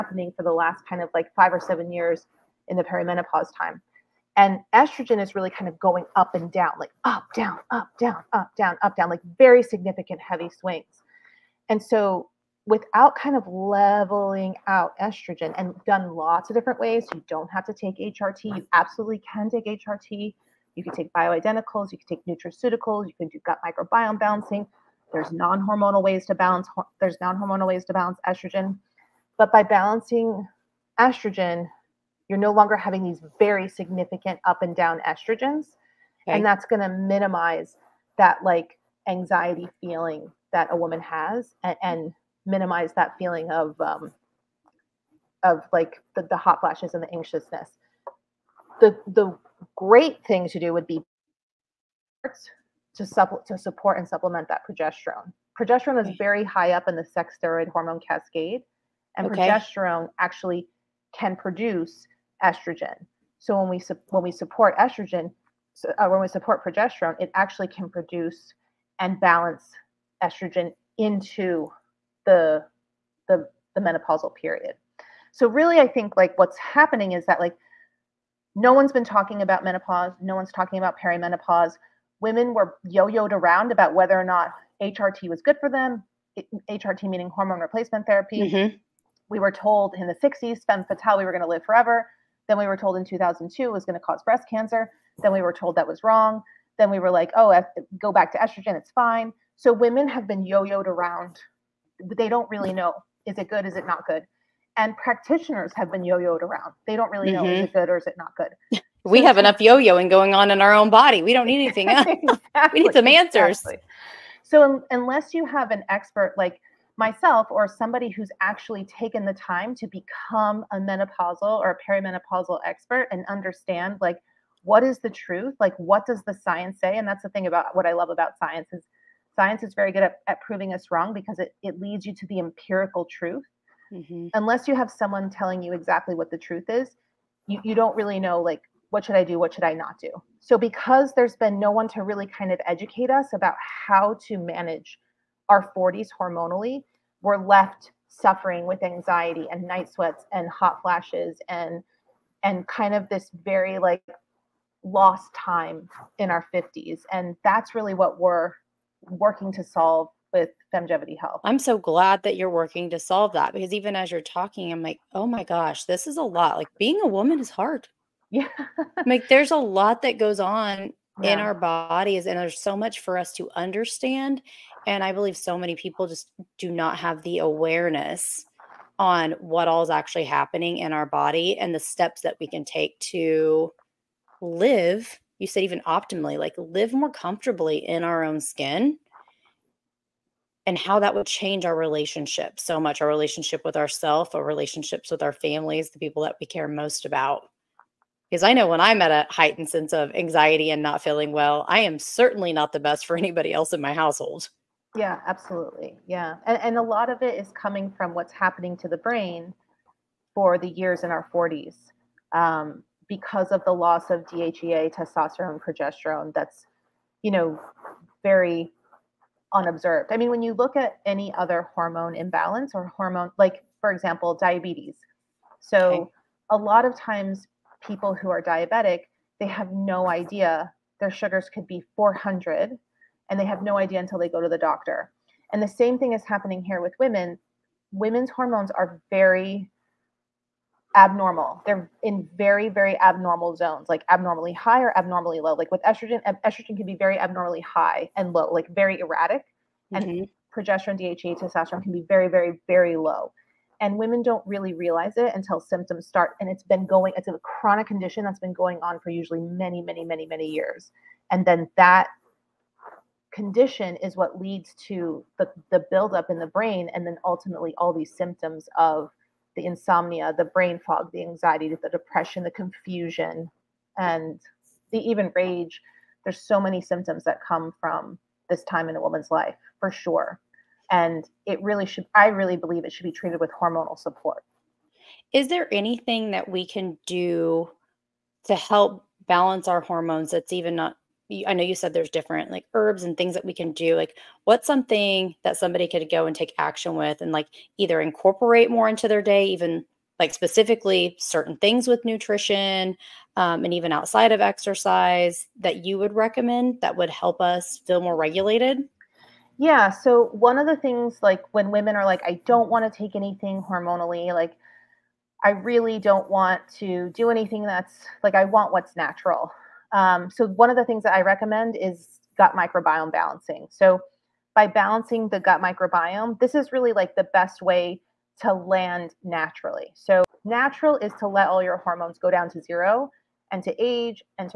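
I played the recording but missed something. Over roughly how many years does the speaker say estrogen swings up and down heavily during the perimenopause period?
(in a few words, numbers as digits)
5 or 7 years.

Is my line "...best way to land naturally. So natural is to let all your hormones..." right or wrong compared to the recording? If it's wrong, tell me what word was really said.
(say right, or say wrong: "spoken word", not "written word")
right.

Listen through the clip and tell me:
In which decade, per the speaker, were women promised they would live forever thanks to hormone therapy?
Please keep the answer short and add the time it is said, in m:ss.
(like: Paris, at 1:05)
1960s, at 1:30.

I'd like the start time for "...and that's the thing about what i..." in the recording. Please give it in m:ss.
2:06.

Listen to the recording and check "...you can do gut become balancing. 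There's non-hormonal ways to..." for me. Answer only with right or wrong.
wrong.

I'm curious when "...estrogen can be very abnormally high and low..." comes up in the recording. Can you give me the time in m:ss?
4:06.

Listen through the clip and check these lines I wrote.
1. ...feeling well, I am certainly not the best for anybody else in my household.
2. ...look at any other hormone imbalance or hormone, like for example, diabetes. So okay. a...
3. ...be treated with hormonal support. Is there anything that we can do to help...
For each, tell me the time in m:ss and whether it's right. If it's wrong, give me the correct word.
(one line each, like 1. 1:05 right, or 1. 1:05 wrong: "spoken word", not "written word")
1. 3:21 right
2. 3:40 right
3. 4:43 right.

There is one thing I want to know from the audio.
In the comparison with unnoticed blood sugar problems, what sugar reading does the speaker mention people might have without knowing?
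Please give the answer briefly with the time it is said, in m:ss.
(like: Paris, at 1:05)
400, at 3:51.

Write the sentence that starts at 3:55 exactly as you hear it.
And the same thing is happening here with women.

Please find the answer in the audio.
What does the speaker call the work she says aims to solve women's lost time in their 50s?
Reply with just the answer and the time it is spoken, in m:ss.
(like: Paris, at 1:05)
Longevity Health, at 2:40.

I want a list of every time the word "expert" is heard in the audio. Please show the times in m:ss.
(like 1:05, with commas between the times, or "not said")
1:55, 2:02.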